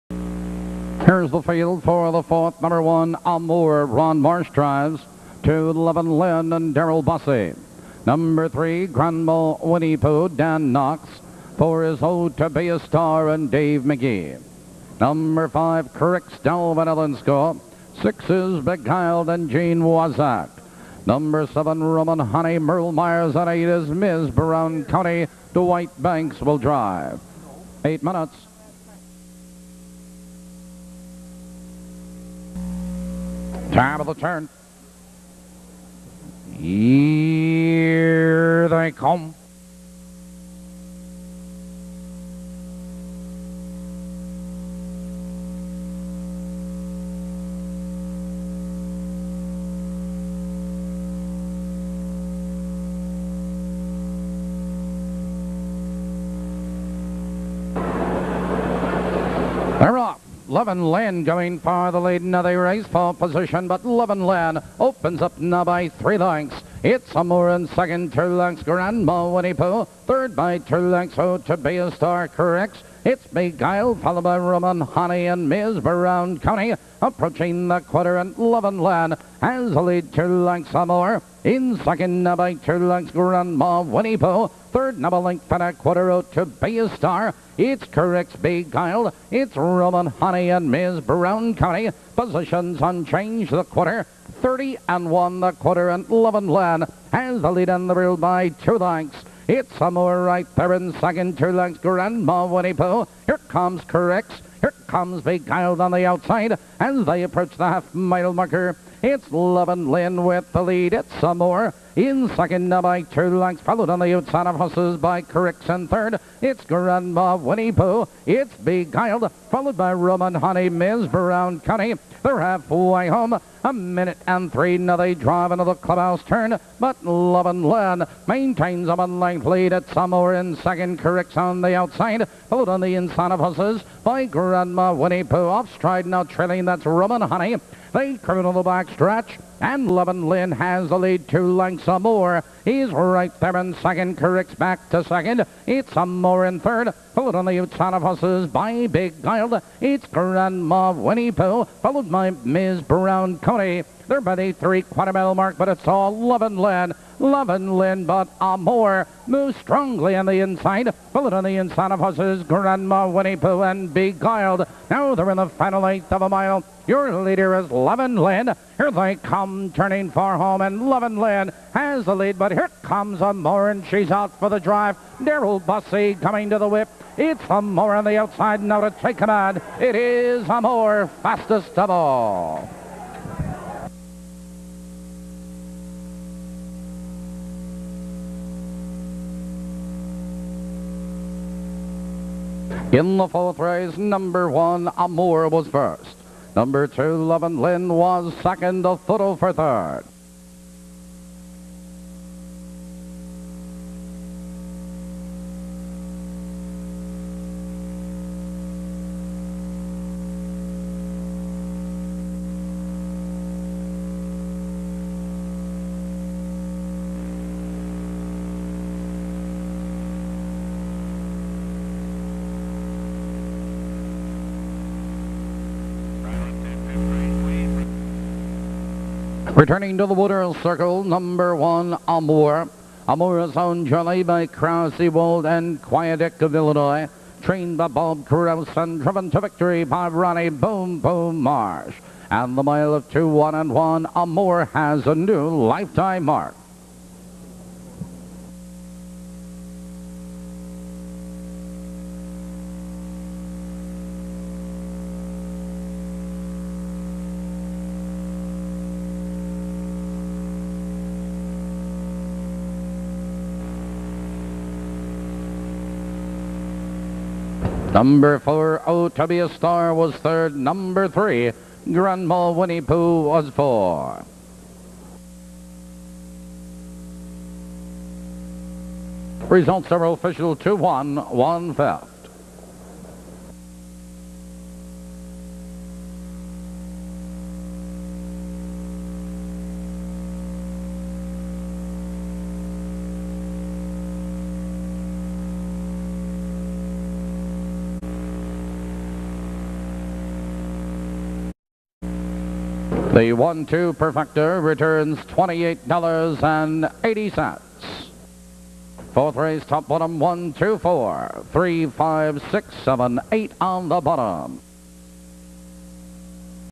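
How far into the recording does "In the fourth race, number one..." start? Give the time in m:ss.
3:12.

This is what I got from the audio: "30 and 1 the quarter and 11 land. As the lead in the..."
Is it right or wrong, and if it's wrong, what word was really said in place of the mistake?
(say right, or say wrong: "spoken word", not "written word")
right.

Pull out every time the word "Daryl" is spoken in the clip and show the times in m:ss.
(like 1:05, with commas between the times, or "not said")
0:06, 2:55.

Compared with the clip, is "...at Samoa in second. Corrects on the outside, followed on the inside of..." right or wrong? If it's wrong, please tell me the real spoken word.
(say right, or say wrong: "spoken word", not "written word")
right.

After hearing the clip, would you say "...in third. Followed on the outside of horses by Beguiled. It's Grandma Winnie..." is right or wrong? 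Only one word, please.
right.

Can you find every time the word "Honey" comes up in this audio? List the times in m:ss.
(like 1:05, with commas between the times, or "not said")
0:22, 1:14, 1:30, 2:00, 2:17.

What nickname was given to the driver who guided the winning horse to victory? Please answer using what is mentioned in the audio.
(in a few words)
Boom Boom.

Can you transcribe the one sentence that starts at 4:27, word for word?
Number four, Oh to be a Star was third.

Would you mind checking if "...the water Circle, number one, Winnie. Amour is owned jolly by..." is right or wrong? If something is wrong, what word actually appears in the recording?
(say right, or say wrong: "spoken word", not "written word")
wrong: "Amour", not "Winnie".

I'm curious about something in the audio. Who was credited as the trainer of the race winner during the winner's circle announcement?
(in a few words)
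Bob Krause.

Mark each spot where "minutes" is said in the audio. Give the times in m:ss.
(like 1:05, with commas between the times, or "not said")
0:28, 2:03.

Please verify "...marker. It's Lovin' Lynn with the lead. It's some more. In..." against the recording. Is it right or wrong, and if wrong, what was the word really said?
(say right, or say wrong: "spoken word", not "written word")
right.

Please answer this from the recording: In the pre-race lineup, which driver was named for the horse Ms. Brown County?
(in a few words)
Dwight Banks.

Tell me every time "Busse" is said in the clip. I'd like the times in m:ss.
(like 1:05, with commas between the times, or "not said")
0:07, 2:55.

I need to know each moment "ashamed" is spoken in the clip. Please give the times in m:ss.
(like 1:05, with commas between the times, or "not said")
not said.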